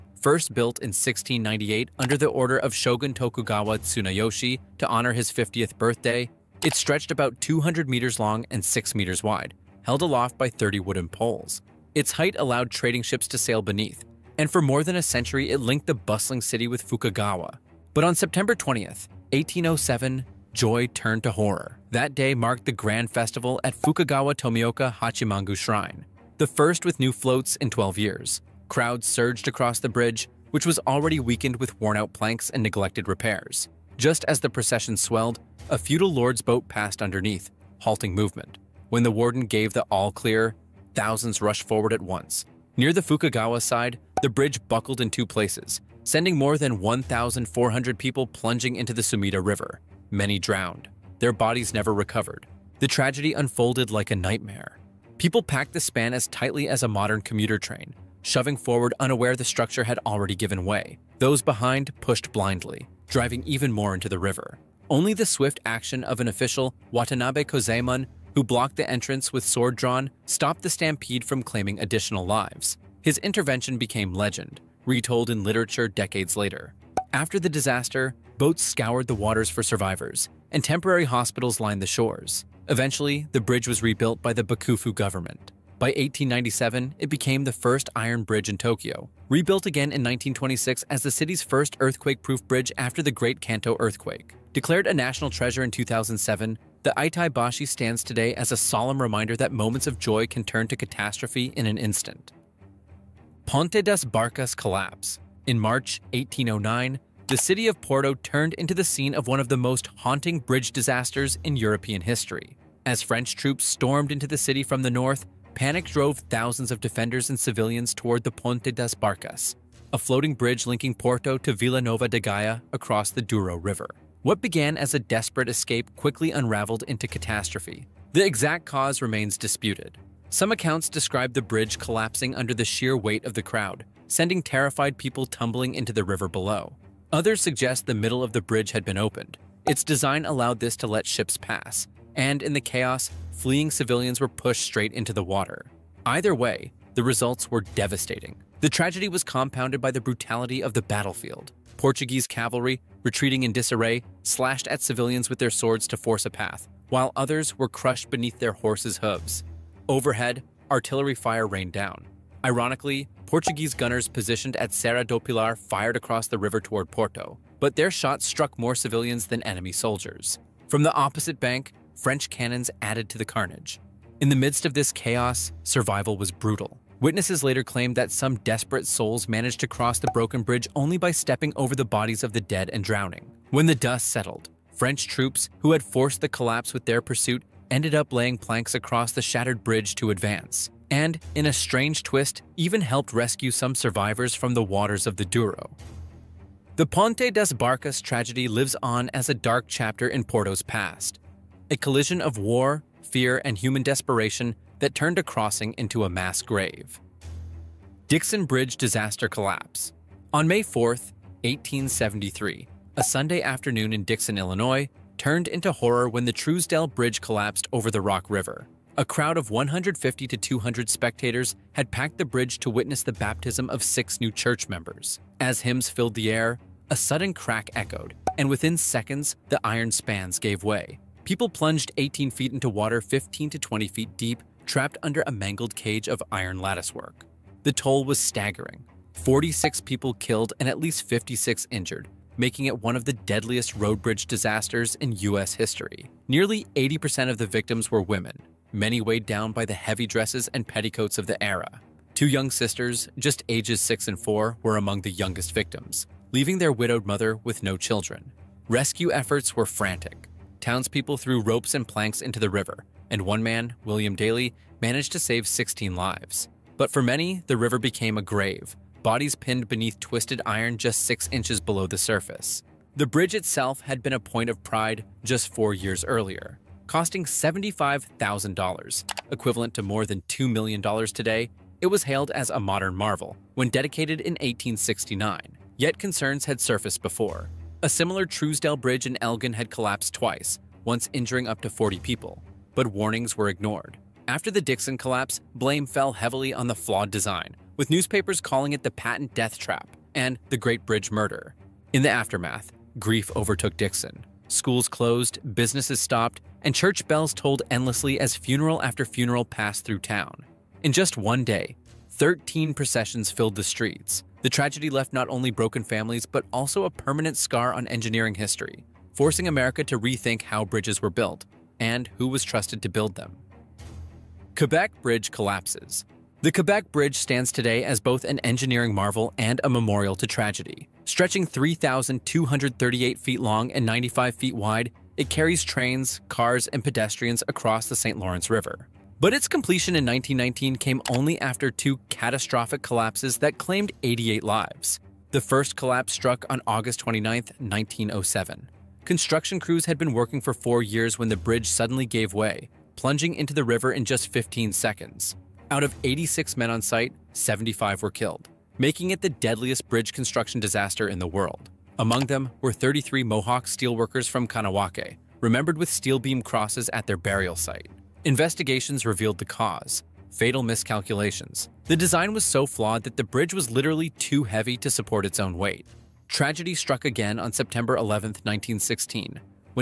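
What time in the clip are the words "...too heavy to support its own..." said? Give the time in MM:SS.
06:14.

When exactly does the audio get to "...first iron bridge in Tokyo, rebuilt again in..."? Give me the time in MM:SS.
01:27.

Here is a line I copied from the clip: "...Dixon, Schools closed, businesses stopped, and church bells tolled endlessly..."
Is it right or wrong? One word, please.
right.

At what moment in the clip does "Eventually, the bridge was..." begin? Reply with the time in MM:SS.
01:22.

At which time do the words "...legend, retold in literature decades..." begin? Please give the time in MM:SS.
01:14.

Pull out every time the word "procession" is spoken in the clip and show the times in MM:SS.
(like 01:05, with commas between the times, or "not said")
00:34, 05:12.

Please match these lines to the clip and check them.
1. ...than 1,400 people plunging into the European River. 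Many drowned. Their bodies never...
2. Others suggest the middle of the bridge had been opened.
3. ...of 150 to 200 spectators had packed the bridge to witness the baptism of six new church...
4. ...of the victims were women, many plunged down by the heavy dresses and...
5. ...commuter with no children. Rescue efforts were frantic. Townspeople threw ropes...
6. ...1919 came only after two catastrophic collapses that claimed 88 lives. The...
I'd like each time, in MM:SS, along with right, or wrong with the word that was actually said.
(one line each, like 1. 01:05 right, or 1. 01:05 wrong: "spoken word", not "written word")
1. 00:46 wrong: "Sumida", not "European"
2. 02:17 right
3. 03:39 right
4. 04:07 wrong: "weighed", not "plunged"
5. 04:17 wrong: "mother", not "commuter"
6. 05:40 right.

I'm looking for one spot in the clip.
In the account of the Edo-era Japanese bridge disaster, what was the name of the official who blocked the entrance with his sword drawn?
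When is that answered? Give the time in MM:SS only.
01:06.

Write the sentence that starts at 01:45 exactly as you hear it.
In March 1809, the city of Porto turned into the scene of one of the most haunting bridge disasters in European history.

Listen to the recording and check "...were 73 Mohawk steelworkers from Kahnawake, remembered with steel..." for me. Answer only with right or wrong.
wrong.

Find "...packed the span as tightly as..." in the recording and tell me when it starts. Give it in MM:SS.
00:55.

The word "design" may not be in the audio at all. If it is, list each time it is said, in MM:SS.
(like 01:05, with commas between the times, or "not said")
02:19, 04:57, 06:11.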